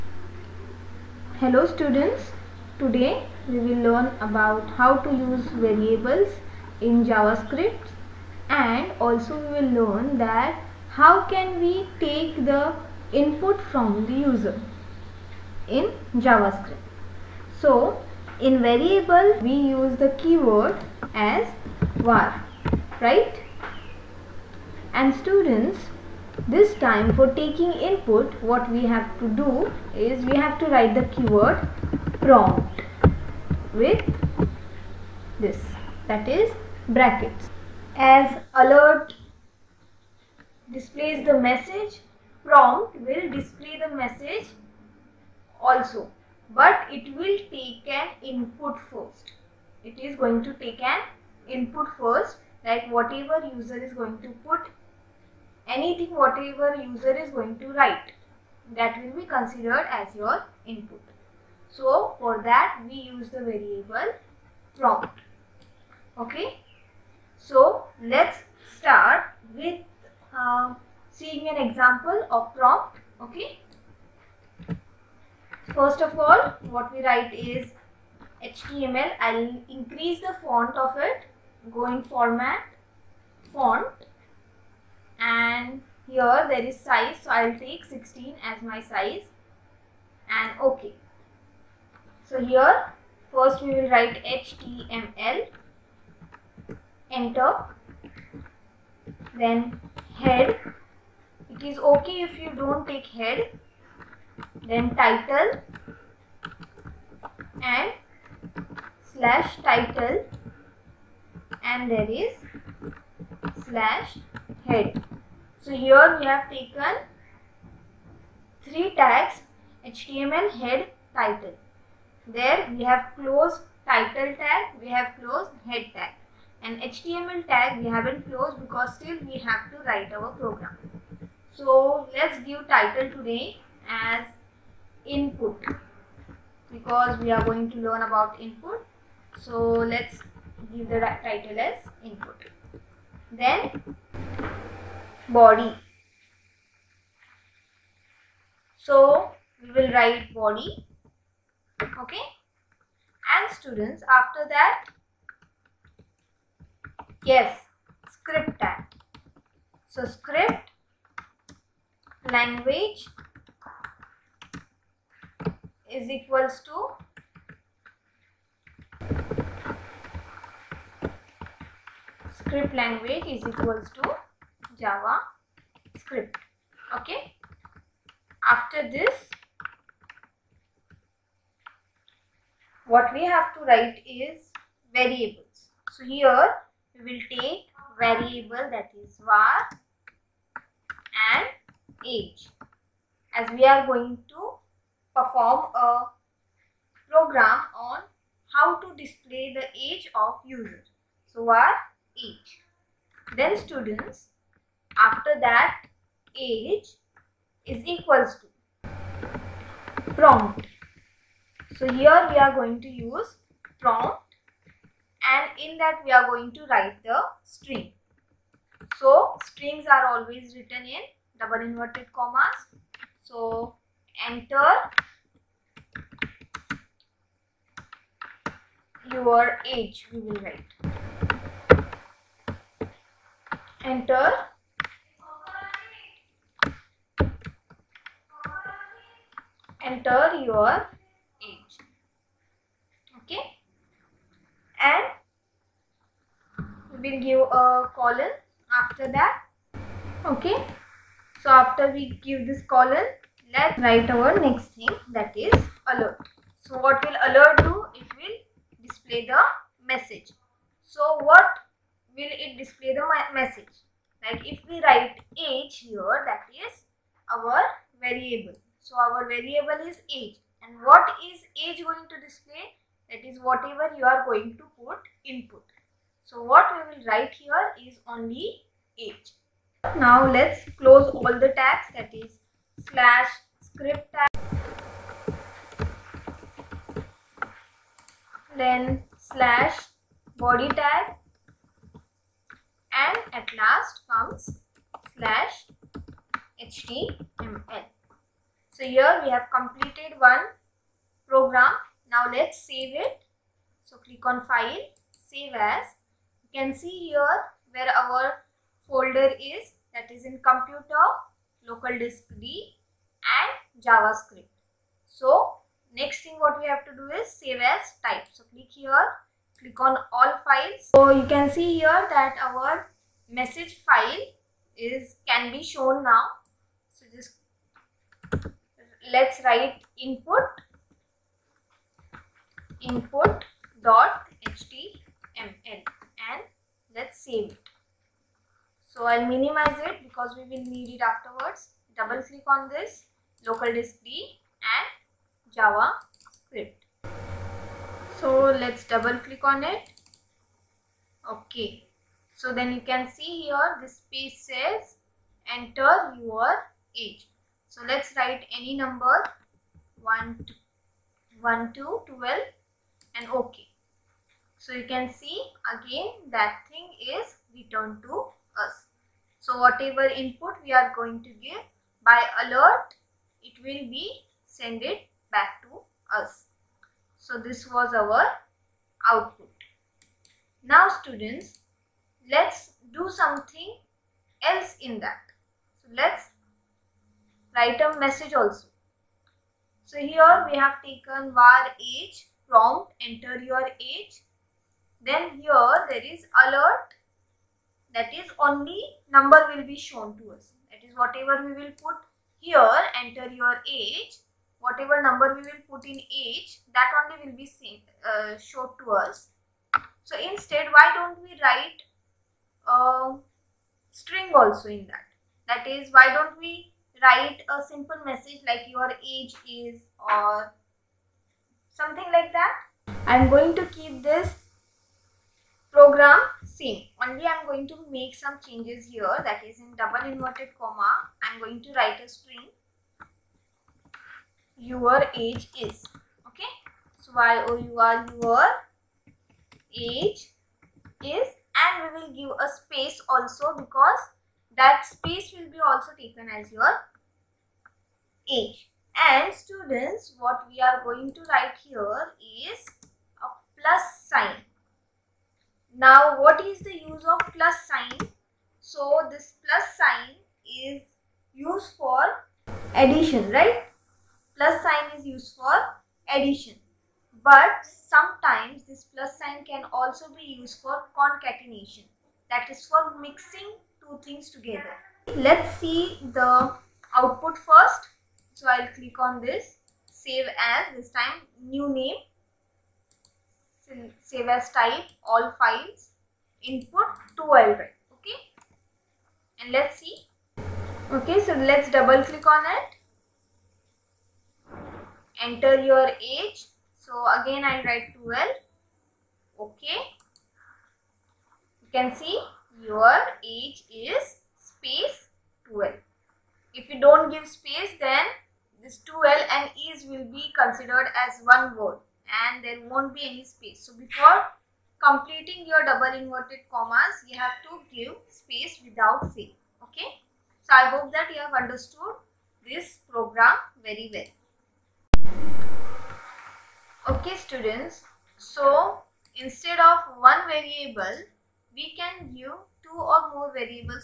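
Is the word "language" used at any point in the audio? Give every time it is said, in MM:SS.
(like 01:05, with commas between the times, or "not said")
02:42, 02:52.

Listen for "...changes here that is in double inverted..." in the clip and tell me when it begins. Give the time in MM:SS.
07:08.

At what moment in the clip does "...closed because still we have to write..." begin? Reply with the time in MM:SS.
02:08.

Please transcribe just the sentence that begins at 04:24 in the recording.
Like if we write age here, that is our variable.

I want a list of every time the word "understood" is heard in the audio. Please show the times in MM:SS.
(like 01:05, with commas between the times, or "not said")
08:41.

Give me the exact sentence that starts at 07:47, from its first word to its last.
But sometimes this plus sign can also be used for concatenation.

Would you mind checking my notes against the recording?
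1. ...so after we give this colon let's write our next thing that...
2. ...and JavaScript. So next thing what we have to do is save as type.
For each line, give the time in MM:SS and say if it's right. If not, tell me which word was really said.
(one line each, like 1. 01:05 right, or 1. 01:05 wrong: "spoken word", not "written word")
1. 04:11 right
2. 05:13 right.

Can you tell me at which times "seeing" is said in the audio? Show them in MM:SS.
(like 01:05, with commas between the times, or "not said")
01:11.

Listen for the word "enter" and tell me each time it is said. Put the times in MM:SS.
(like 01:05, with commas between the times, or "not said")
01:37, 03:44, 03:53, 03:59, 05:55, 06:33, 06:43, 08:15.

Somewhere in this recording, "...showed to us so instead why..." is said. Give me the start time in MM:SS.
06:48.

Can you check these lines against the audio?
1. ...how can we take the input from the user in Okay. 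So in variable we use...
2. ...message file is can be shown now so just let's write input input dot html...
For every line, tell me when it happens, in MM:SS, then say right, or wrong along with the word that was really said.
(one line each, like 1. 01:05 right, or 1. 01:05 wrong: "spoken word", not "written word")
1. 00:10 wrong: "JavaScript", not "Okay"
2. 05:23 right.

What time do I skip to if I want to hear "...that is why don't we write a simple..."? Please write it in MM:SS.
06:55.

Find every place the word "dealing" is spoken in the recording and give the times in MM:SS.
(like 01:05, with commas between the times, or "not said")
not said.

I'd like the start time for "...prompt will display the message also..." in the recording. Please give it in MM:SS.
00:42.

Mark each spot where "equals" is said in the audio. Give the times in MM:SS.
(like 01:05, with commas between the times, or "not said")
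02:46, 02:53, 03:27.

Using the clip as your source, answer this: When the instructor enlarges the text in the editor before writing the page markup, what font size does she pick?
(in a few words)
16.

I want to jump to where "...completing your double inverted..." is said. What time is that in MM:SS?
08:34.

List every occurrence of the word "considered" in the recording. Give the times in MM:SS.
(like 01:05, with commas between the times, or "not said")
00:59, 08:30.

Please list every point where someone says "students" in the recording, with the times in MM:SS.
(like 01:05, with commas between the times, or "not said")
00:01, 00:25, 02:33, 03:23, 06:20, 07:29, 08:47.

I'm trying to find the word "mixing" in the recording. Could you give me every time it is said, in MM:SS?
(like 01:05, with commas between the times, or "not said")
07:53.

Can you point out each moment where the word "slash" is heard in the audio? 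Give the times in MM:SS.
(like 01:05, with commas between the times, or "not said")
01:49, 01:53, 04:42, 04:49, 04:55.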